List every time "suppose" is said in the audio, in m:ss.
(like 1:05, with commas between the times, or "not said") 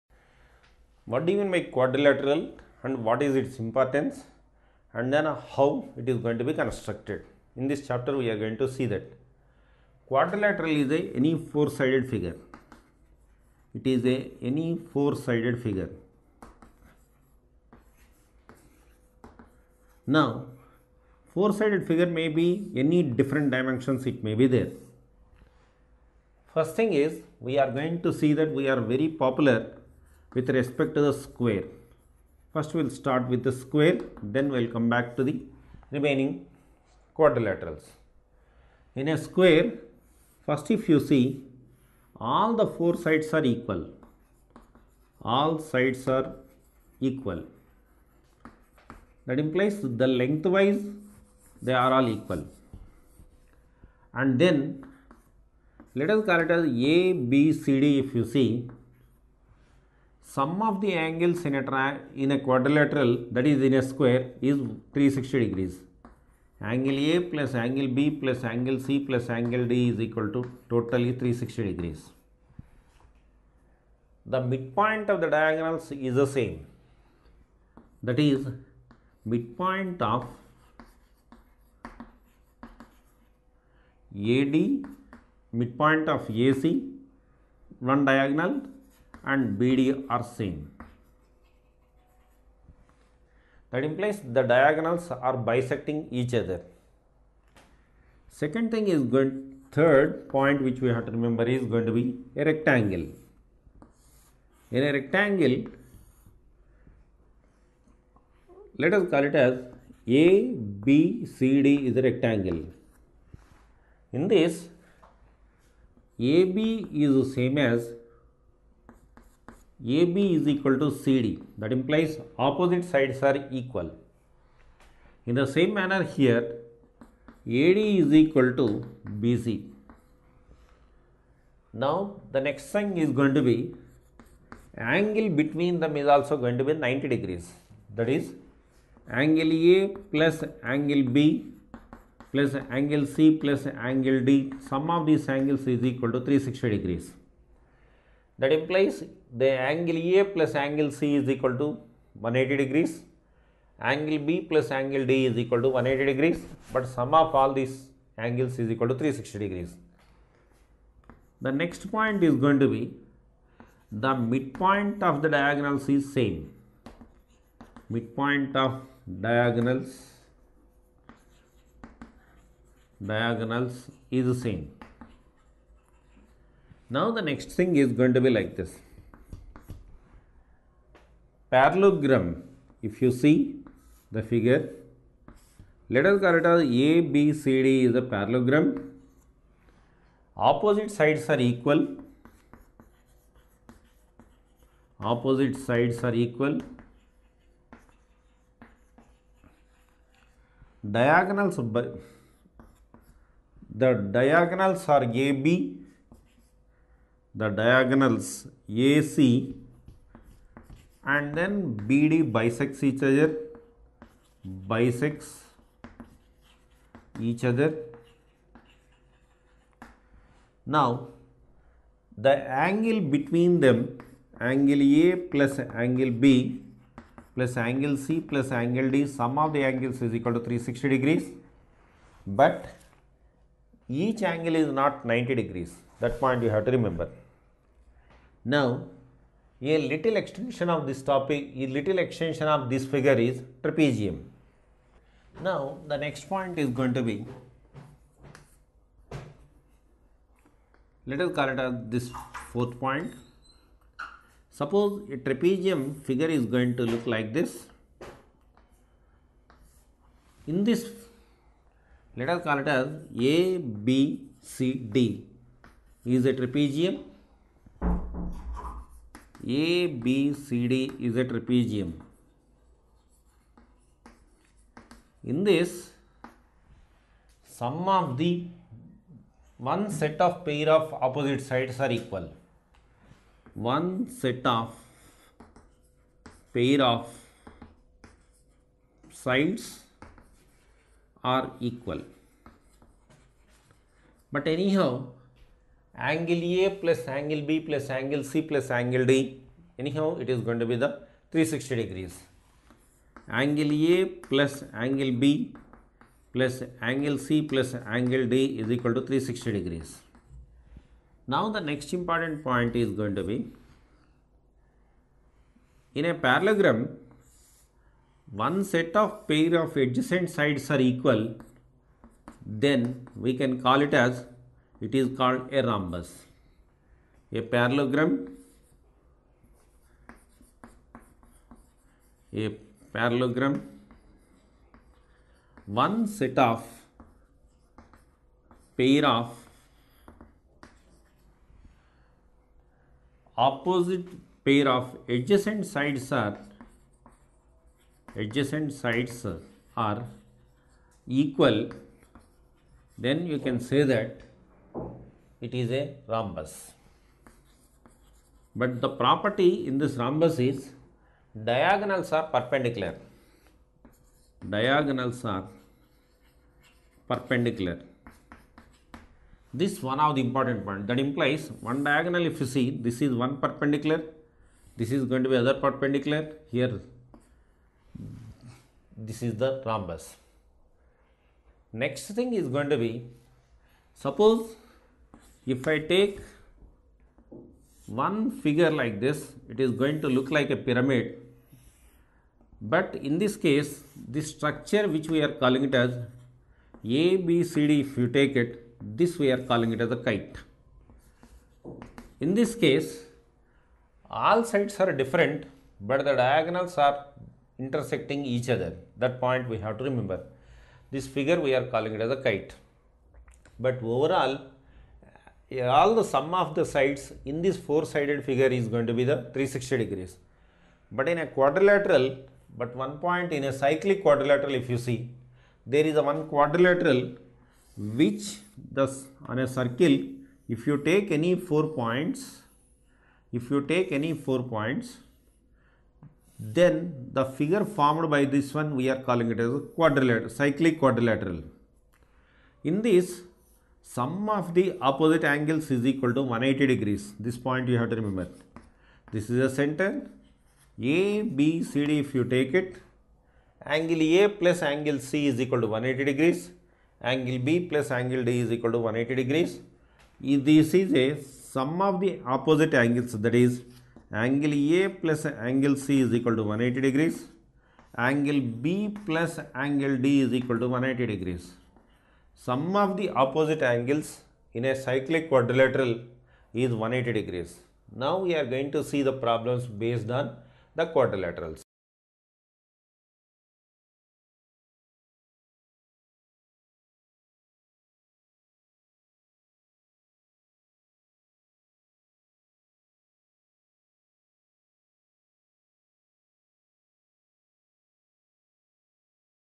4:14, 6:23.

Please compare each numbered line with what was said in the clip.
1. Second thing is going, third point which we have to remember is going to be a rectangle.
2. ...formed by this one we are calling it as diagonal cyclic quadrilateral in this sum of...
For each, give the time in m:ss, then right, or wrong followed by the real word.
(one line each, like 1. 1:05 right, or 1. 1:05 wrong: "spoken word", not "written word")
1. 1:38 right
2. 7:17 wrong: "quadrilateral", not "diagonal".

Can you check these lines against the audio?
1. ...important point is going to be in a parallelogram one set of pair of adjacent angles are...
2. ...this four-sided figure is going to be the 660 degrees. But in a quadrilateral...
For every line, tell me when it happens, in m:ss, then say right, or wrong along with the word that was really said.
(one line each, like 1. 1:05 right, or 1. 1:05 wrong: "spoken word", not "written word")
1. 5:11 wrong: "sides", not "angles"
2. 6:57 wrong: "360", not "660".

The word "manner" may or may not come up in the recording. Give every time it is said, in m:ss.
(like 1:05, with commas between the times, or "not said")
2:05.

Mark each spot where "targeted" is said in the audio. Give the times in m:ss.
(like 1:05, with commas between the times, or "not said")
not said.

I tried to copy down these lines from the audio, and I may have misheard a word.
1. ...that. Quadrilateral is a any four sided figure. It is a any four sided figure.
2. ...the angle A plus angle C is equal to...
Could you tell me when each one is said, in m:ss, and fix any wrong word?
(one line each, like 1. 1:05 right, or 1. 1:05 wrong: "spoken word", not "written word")
1. 0:08 right
2. 2:29 right.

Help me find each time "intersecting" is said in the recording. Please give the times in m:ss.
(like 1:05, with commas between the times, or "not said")
6:47.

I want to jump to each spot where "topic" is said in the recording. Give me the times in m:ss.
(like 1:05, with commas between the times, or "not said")
4:01.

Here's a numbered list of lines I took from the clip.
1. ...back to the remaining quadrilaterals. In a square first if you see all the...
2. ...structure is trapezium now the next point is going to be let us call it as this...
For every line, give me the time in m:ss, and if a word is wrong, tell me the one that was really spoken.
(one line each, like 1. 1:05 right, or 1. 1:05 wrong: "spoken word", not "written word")
1. 0:34 right
2. 4:02 wrong: "figure", not "structure".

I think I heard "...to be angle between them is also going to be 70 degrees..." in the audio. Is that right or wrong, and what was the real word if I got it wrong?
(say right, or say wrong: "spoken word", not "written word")
wrong: "90", not "70".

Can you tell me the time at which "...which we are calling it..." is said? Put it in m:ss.
6:34.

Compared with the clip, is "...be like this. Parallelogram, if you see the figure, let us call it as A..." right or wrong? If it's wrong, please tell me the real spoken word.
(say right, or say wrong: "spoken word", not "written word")
right.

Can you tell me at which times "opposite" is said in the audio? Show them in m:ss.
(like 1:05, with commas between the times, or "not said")
2:02, 3:10, 3:14, 4:40, 5:43, 7:24, 7:42, 7:53.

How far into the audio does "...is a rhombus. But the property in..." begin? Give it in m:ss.
5:55.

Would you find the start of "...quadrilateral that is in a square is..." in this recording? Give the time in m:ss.
1:02.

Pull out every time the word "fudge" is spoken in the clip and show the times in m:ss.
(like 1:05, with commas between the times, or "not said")
not said.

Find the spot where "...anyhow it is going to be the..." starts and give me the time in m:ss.
4:59.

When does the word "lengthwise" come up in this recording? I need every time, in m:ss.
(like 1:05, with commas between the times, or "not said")
0:50.